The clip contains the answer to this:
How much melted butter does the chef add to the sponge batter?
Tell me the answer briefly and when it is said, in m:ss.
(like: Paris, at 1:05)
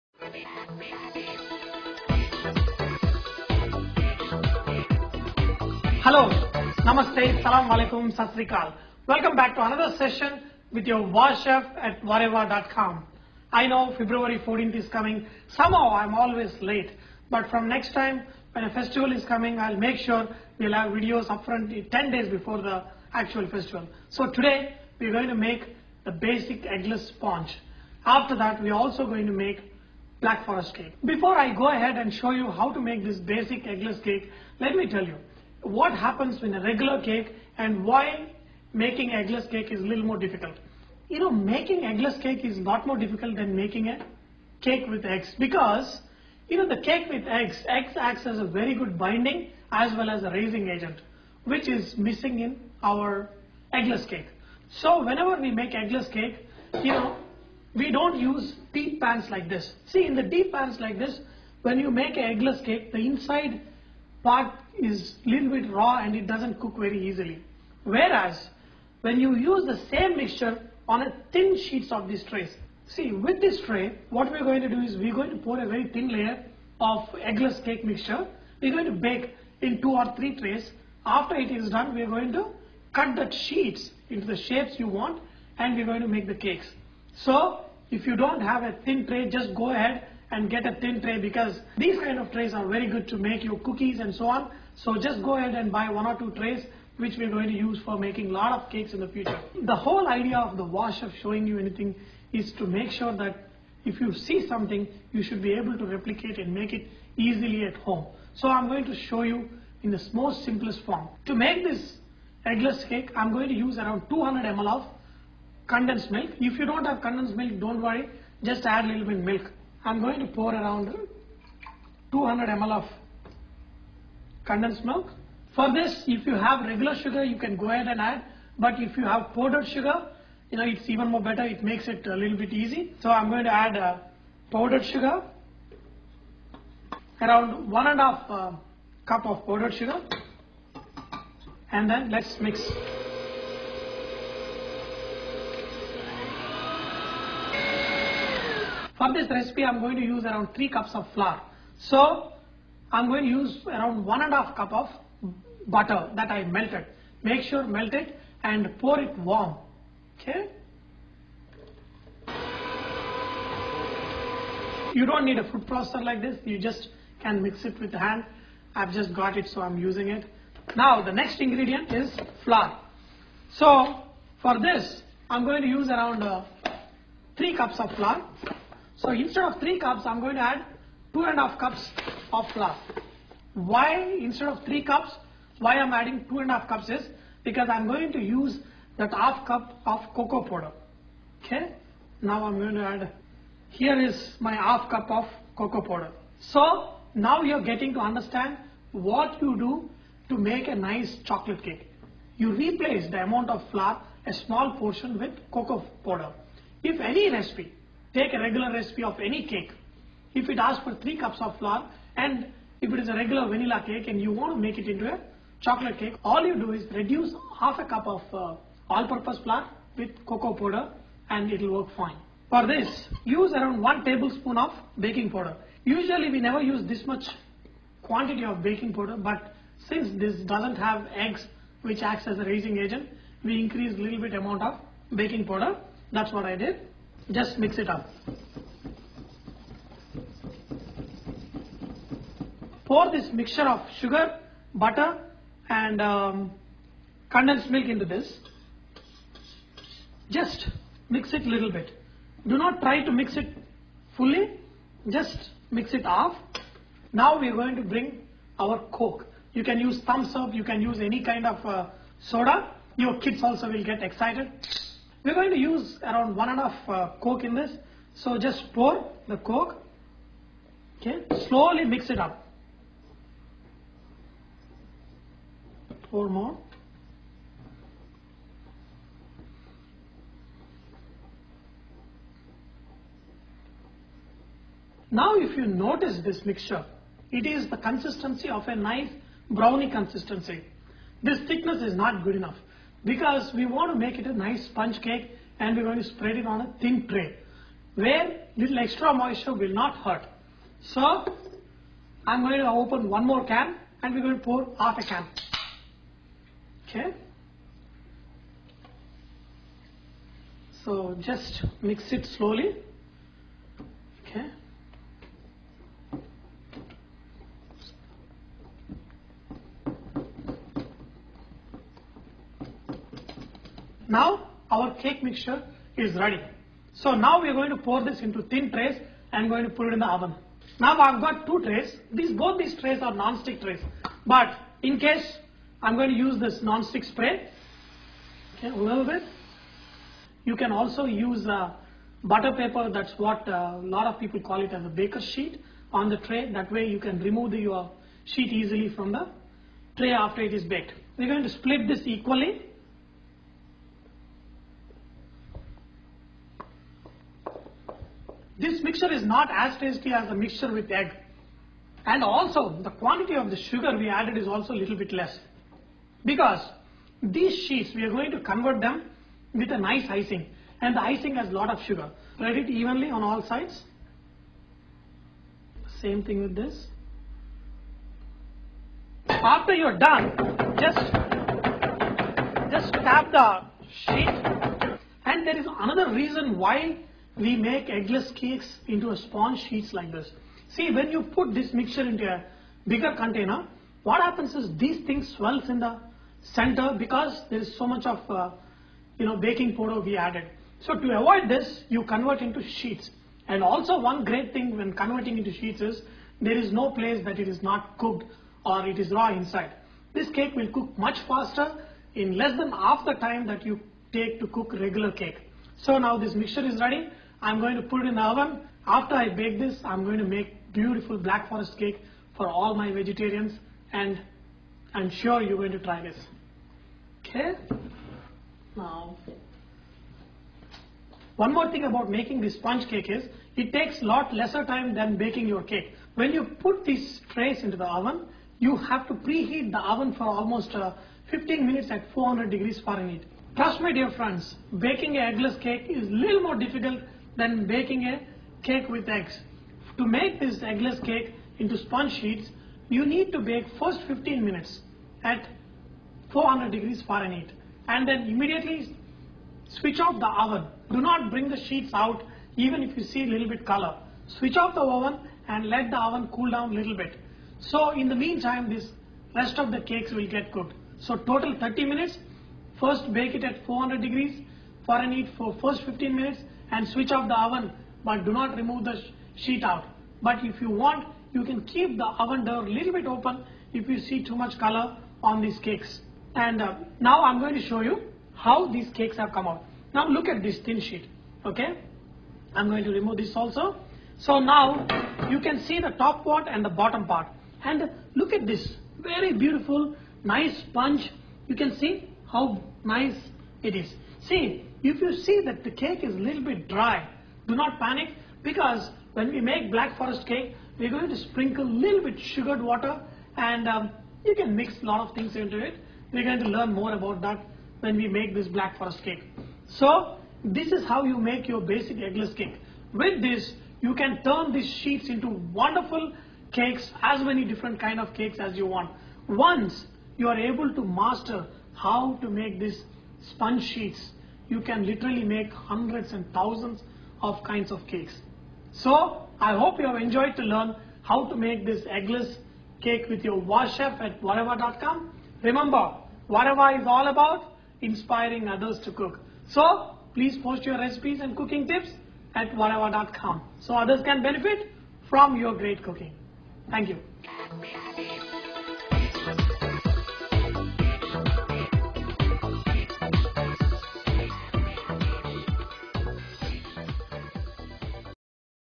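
1.5 cups, at 2:34.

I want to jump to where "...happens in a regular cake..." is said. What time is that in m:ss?
0:35.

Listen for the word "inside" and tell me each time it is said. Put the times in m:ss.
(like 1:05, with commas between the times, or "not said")
1:03, 6:49.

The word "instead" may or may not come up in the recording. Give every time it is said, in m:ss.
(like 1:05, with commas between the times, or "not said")
2:59, 3:04.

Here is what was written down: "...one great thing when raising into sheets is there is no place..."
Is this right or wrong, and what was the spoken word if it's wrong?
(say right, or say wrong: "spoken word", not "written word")
wrong: "converting", not "raising".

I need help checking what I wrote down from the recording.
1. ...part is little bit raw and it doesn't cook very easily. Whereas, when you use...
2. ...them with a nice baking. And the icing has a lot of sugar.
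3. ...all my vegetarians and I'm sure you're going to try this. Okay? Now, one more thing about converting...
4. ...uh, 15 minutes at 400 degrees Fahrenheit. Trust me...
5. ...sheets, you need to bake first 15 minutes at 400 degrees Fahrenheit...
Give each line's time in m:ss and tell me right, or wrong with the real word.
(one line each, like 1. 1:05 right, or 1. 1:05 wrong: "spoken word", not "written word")
1. 1:04 right
2. 6:08 wrong: "icing", not "baking"
3. 7:02 wrong: "making", not "converting"
4. 7:20 right
5. 7:32 right.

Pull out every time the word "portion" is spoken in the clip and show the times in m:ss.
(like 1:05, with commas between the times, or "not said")
3:24.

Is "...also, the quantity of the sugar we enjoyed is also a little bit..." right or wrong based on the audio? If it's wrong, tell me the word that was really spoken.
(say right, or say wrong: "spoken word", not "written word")
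wrong: "added", not "enjoyed".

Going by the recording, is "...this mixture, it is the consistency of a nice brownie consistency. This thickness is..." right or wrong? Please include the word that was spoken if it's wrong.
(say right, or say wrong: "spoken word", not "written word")
right.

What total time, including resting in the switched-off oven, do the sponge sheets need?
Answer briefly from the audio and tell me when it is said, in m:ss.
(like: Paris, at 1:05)
30 minutes, at 7:51.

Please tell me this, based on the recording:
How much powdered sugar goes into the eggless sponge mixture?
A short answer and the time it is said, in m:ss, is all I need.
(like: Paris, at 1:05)
1.5 cups, at 2:17.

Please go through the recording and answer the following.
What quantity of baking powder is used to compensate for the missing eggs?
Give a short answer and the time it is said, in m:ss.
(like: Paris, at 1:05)
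1 tablespoon, at 3:43.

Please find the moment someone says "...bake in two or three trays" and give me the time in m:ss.
1:18.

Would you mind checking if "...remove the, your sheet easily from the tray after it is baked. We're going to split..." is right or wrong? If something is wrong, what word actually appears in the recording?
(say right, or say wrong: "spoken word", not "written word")
right.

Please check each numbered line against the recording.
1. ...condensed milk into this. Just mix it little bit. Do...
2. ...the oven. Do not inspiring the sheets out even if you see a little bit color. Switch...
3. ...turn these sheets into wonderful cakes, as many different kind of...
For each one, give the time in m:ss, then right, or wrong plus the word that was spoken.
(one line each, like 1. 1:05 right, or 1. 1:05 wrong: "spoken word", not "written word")
1. 4:07 right
2. 7:40 wrong: "bring", not "inspiring"
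3. 8:44 right.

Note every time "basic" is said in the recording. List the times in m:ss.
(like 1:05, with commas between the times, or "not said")
0:26, 0:33, 8:41.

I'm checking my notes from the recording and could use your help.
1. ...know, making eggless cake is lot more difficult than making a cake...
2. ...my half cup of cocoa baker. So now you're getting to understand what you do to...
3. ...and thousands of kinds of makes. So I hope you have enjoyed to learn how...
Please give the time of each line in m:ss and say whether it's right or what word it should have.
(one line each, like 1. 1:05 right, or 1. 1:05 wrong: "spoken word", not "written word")
1. 0:41 right
2. 3:14 wrong: "powder", not "baker"
3. 8:56 wrong: "cakes", not "makes".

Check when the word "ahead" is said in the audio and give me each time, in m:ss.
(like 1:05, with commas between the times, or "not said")
0:31, 1:29, 1:35, 2:07.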